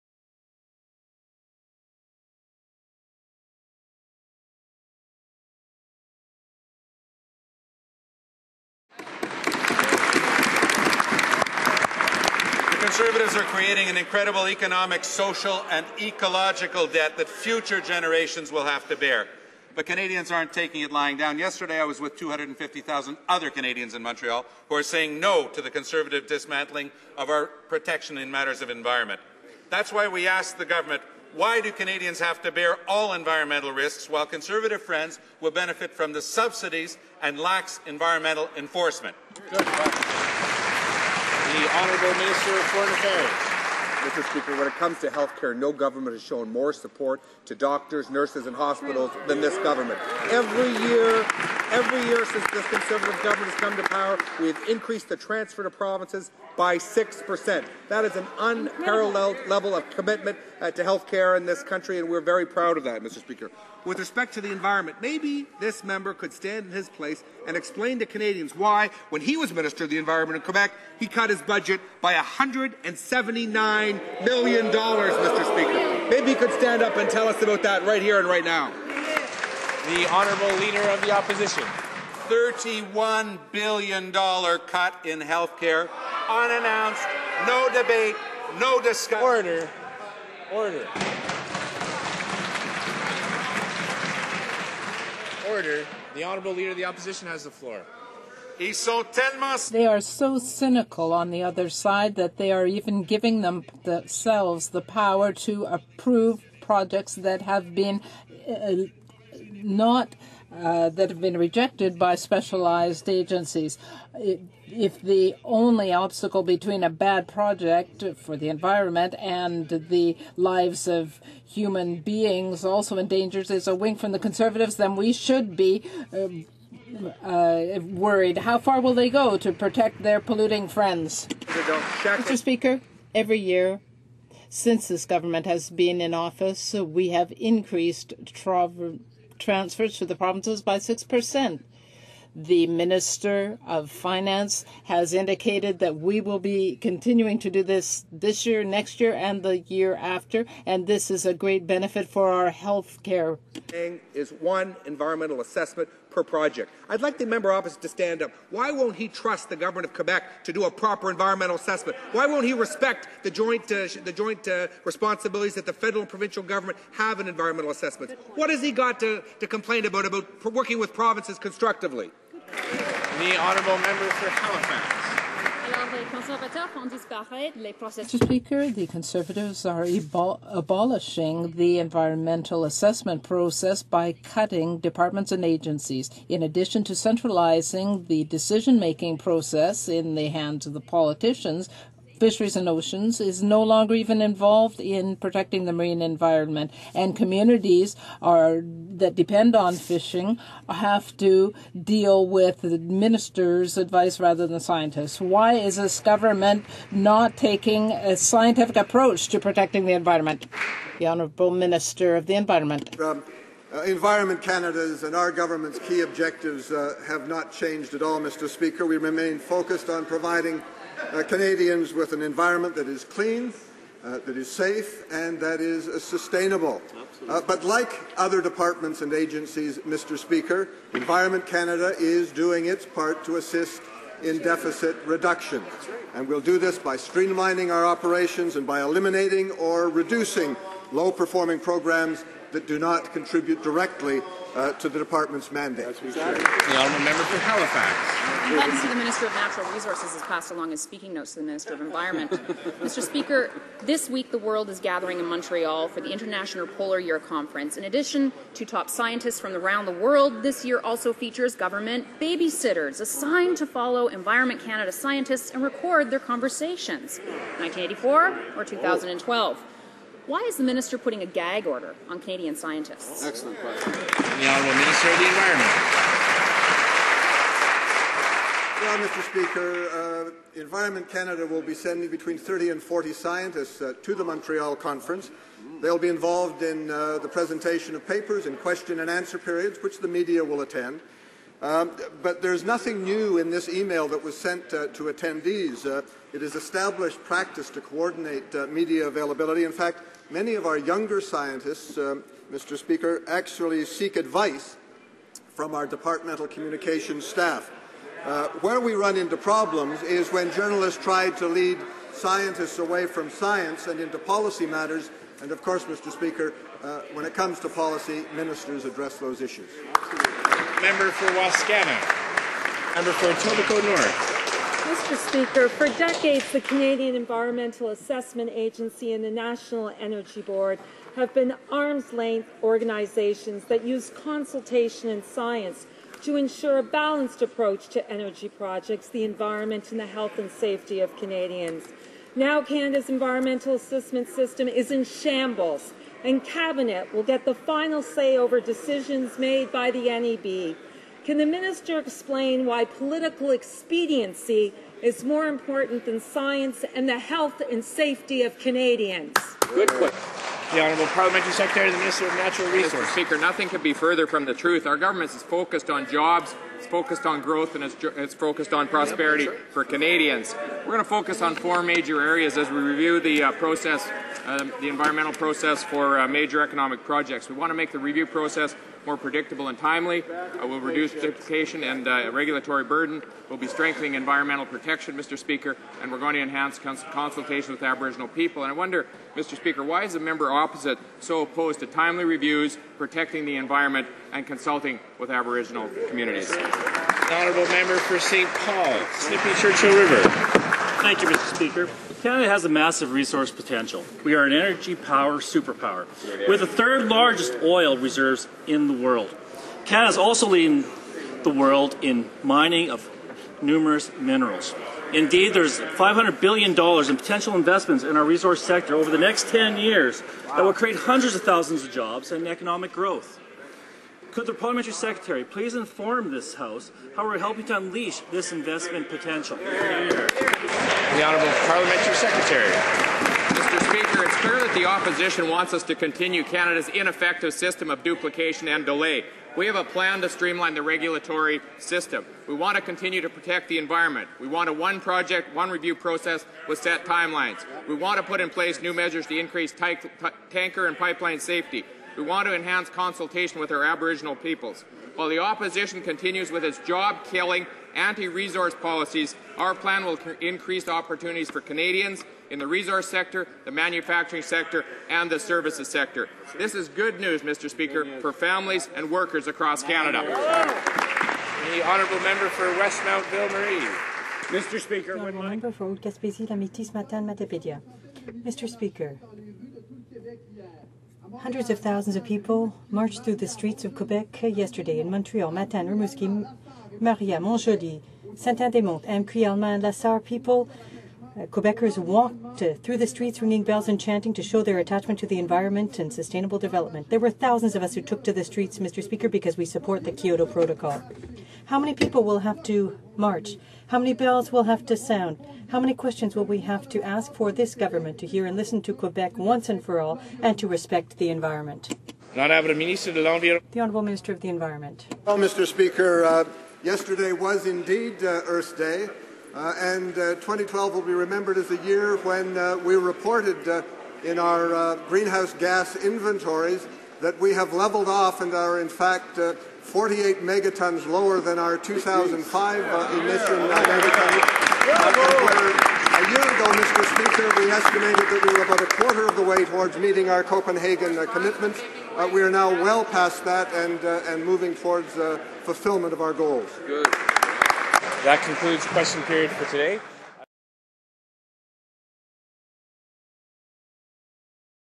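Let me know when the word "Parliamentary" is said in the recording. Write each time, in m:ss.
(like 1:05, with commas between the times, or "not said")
6:01, 7:04, 7:11.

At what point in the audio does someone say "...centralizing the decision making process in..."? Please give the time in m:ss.
3:06.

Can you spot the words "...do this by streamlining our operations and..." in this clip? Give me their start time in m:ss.
3:56.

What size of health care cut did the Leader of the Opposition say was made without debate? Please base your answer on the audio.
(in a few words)
$31 billion.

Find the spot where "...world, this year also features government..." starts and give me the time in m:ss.
4:19.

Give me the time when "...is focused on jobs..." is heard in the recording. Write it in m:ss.
6:05.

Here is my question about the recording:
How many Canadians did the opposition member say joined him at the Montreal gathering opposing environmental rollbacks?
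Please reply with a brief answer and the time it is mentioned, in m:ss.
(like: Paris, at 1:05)
250,000, at 0:22.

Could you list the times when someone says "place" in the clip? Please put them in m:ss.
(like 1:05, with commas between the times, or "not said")
1:06, 7:28.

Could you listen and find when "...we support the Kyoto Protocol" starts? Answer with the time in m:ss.
8:19.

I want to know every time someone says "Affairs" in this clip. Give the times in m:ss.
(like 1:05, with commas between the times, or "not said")
0:42.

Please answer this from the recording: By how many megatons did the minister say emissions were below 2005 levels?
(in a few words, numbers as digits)
48.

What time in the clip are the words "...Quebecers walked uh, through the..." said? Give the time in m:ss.
8:11.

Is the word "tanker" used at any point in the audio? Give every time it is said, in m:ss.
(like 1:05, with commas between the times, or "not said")
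7:30.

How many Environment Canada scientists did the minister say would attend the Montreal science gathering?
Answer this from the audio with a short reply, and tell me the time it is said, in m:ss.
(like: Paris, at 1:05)
30 to 40, at 4:42.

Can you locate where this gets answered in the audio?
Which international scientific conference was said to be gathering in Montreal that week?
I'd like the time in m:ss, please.
4:16.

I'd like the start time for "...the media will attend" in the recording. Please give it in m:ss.
4:49.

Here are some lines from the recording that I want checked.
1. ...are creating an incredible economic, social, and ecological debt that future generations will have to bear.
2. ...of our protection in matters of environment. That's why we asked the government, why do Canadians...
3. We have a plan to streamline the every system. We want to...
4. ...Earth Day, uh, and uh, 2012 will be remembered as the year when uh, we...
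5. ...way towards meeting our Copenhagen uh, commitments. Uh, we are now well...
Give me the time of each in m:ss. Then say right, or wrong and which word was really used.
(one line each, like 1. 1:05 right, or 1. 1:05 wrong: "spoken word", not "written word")
1. 0:13 right
2. 0:27 right
3. 7:19 wrong: "regulatory", not "every"
4. 8:38 right
5. 8:59 right.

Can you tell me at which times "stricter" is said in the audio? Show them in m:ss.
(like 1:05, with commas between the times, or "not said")
not said.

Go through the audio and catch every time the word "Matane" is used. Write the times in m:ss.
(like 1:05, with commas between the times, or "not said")
7:56, 8:05.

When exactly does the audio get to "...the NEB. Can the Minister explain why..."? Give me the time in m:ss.
5:49.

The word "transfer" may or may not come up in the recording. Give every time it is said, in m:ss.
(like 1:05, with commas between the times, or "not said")
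0:55, 2:19.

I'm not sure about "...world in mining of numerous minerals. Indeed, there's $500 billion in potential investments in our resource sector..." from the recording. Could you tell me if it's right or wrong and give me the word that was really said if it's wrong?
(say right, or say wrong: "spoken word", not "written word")
right.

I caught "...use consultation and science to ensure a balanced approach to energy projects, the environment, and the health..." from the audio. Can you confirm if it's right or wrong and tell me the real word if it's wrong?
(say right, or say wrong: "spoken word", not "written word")
right.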